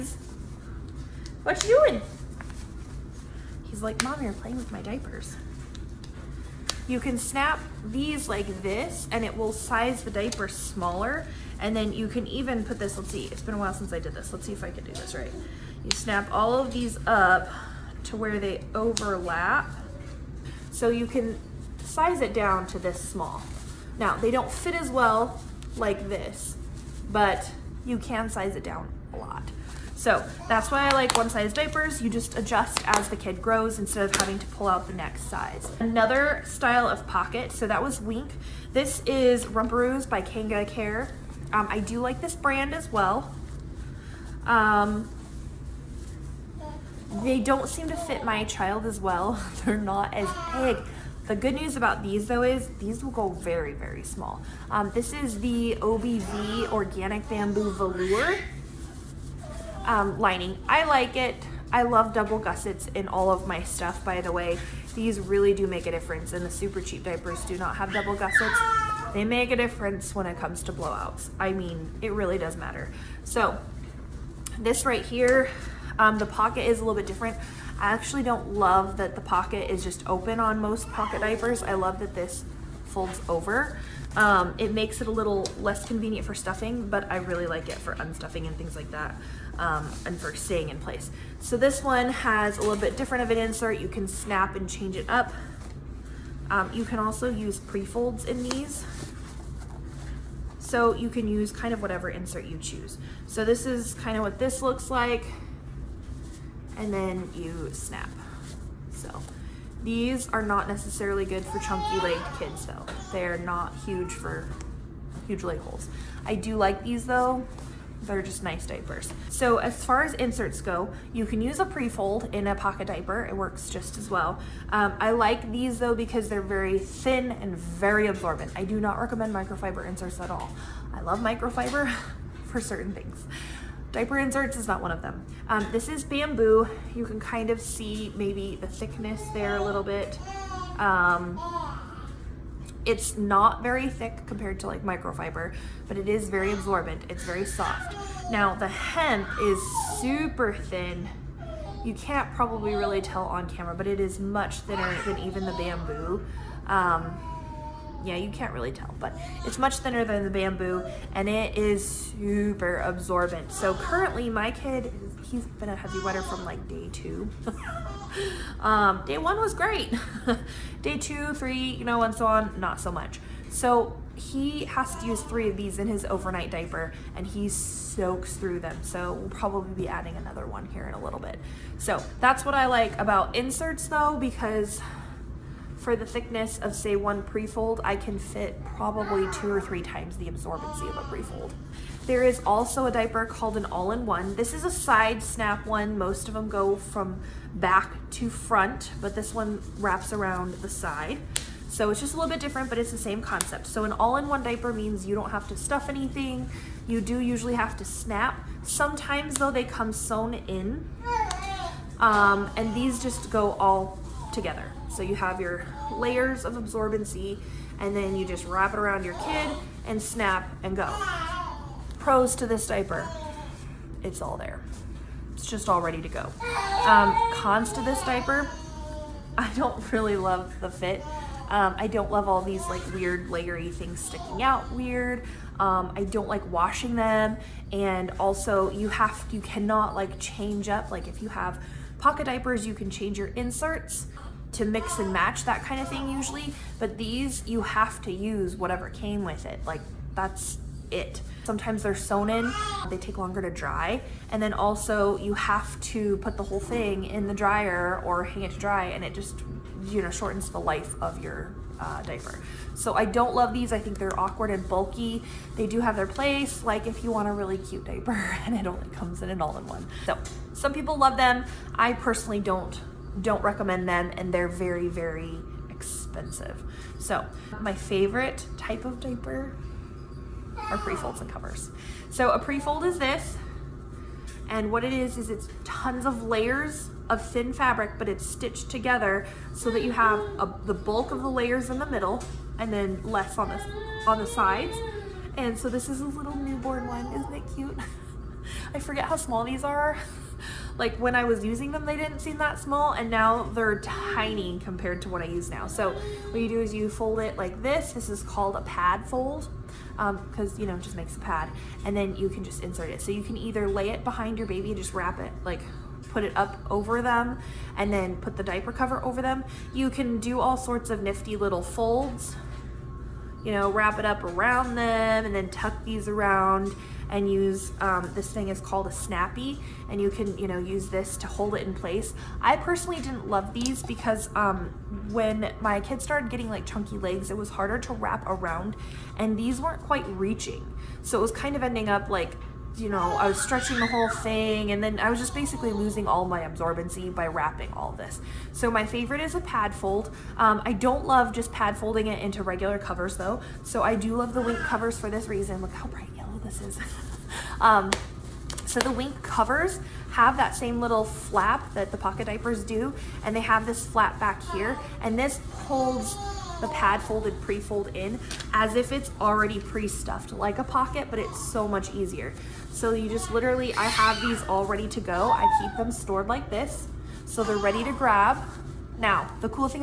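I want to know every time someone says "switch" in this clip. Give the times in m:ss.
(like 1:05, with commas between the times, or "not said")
not said.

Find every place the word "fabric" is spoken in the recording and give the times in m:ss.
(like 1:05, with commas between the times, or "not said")
4:47.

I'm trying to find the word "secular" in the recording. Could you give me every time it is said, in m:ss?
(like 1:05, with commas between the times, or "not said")
not said.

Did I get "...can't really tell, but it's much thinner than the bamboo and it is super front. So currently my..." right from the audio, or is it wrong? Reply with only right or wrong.
wrong.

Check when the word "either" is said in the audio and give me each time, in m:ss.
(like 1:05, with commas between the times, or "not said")
5:13.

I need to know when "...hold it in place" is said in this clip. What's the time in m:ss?
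5:31.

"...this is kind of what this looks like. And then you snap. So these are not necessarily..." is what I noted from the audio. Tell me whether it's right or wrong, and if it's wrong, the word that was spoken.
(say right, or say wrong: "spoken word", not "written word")
right.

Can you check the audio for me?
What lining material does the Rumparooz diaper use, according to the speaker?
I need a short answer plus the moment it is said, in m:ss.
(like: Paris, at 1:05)
Organic Bamboo Velour, at 0:56.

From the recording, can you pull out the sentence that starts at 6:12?
So you just literally, I have these all ready to go.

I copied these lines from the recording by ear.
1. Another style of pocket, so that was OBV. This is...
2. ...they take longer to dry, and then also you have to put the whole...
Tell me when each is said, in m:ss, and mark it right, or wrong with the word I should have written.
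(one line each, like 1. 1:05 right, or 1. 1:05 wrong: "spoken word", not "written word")
1. 0:35 wrong: "Wink", not "OBV"
2. 4:12 right.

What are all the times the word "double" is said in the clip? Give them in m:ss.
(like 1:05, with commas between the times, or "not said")
1:02, 1:07.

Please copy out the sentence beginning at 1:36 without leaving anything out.
Um, you can also use pre-folds in these.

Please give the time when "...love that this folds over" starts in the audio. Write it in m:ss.
1:21.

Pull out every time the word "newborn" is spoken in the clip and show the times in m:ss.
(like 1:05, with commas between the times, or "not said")
4:56.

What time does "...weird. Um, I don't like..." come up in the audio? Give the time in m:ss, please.
3:54.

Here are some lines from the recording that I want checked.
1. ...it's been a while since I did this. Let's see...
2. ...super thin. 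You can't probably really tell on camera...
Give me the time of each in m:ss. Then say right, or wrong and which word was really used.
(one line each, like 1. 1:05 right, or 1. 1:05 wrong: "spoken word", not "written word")
1. 0:13 right
2. 2:30 right.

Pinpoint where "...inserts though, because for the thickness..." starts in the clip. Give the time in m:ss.
3:03.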